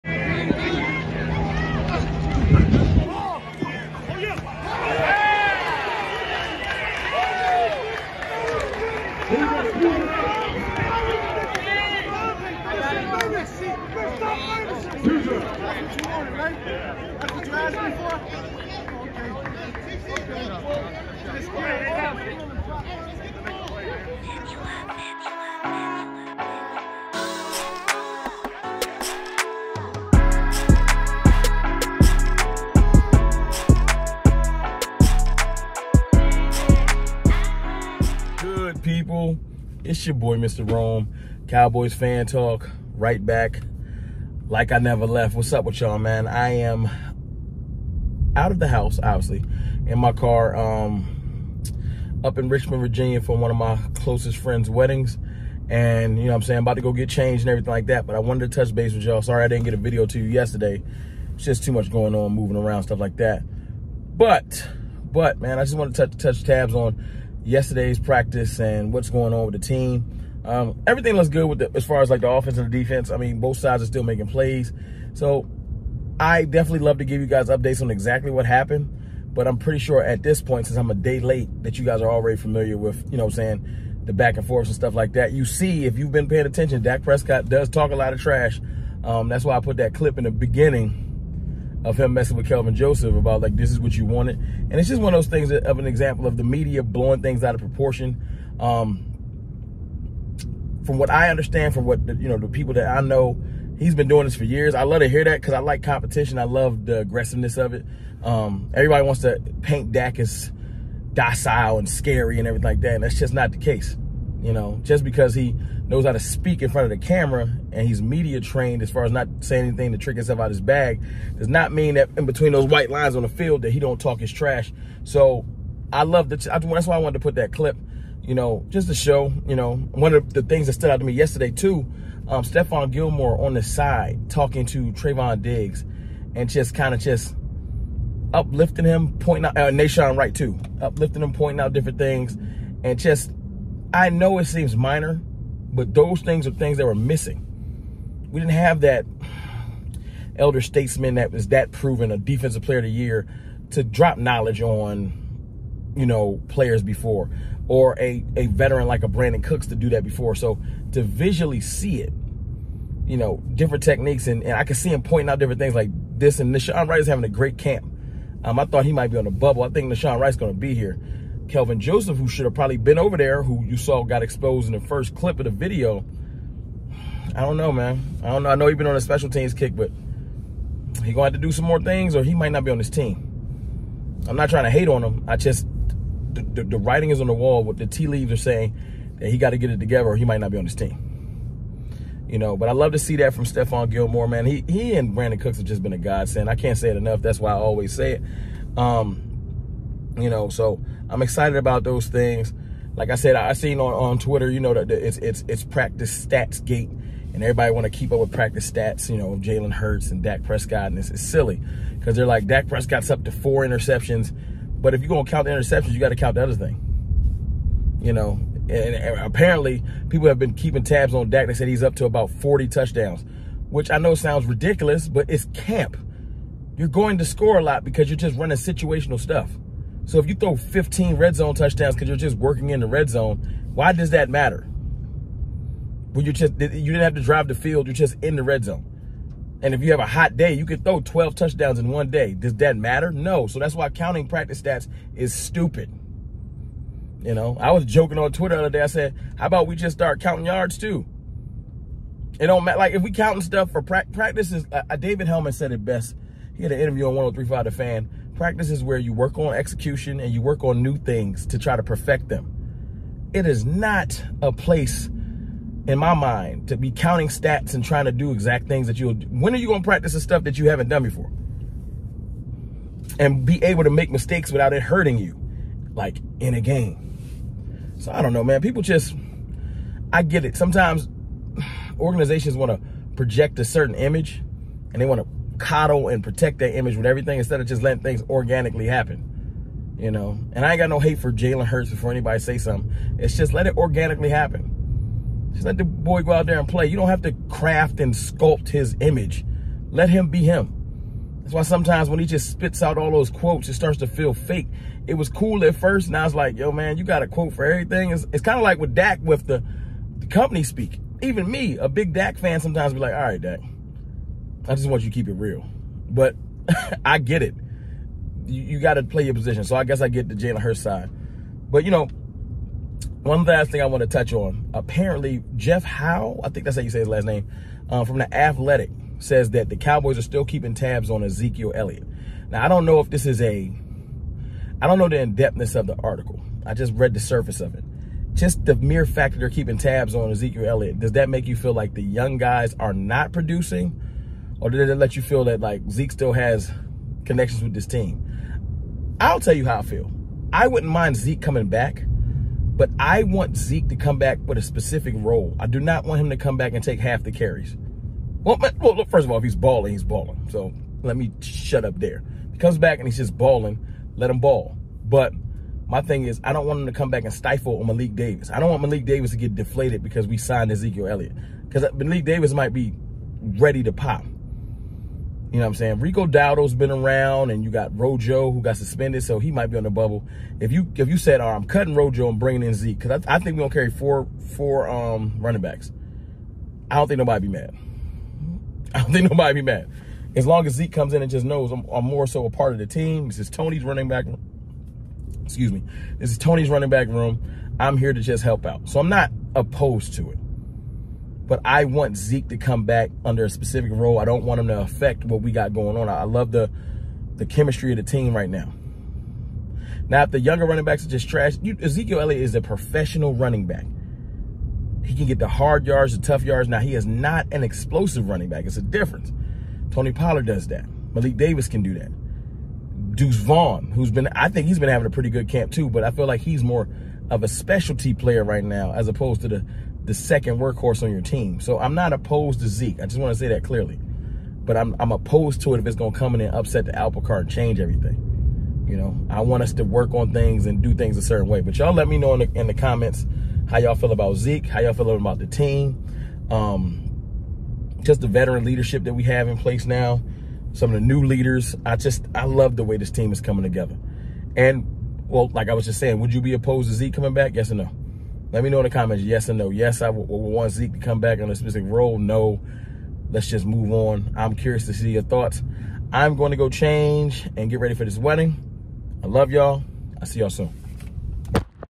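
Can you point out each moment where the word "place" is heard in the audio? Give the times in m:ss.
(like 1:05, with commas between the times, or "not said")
4:24, 7:29.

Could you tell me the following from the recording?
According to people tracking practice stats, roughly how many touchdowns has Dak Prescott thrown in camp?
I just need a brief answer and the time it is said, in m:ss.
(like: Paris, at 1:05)
40, at 3:42.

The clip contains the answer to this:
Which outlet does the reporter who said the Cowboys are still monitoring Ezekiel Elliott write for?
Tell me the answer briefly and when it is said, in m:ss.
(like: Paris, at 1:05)
The Athletic, at 5:28.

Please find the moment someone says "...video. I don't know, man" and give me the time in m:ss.
2:55.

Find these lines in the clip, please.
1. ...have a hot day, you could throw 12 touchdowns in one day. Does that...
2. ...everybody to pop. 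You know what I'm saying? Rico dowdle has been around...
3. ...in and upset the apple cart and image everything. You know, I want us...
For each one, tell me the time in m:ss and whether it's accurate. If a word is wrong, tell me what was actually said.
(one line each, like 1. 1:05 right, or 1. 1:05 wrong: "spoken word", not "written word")
1. 3:59 right
2. 6:13 wrong: "ready", not "everybody"
3. 7:16 wrong: "change", not "image".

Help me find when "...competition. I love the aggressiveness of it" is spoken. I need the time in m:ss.
1:45.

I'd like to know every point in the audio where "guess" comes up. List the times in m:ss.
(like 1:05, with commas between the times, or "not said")
5:19.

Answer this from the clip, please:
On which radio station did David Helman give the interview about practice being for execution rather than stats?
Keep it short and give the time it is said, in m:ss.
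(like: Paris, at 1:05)
1035 The Fan, at 4:17.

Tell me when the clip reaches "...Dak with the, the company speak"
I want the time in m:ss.
5:08.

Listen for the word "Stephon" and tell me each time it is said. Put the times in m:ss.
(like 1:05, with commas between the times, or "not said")
2:12, 3:13.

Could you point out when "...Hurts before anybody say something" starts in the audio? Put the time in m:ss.
4:51.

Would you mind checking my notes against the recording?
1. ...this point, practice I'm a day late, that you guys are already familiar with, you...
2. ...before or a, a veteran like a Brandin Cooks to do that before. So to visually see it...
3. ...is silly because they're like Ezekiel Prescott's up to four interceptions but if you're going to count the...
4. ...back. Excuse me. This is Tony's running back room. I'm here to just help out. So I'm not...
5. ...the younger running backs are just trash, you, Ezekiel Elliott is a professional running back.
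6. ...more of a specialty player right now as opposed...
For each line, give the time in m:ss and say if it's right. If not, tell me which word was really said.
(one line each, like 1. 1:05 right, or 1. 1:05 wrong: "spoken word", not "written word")
1. 1:20 wrong: "since", not "practice"
2. 2:36 right
3. 3:31 wrong: "Dak", not "Ezekiel"
4. 6:34 right
5. 6:50 right
6. 7:06 right.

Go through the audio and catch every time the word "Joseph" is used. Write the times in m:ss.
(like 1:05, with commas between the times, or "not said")
1:32, 2:51.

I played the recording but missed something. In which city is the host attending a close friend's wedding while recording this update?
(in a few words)
Richmond, Virginia.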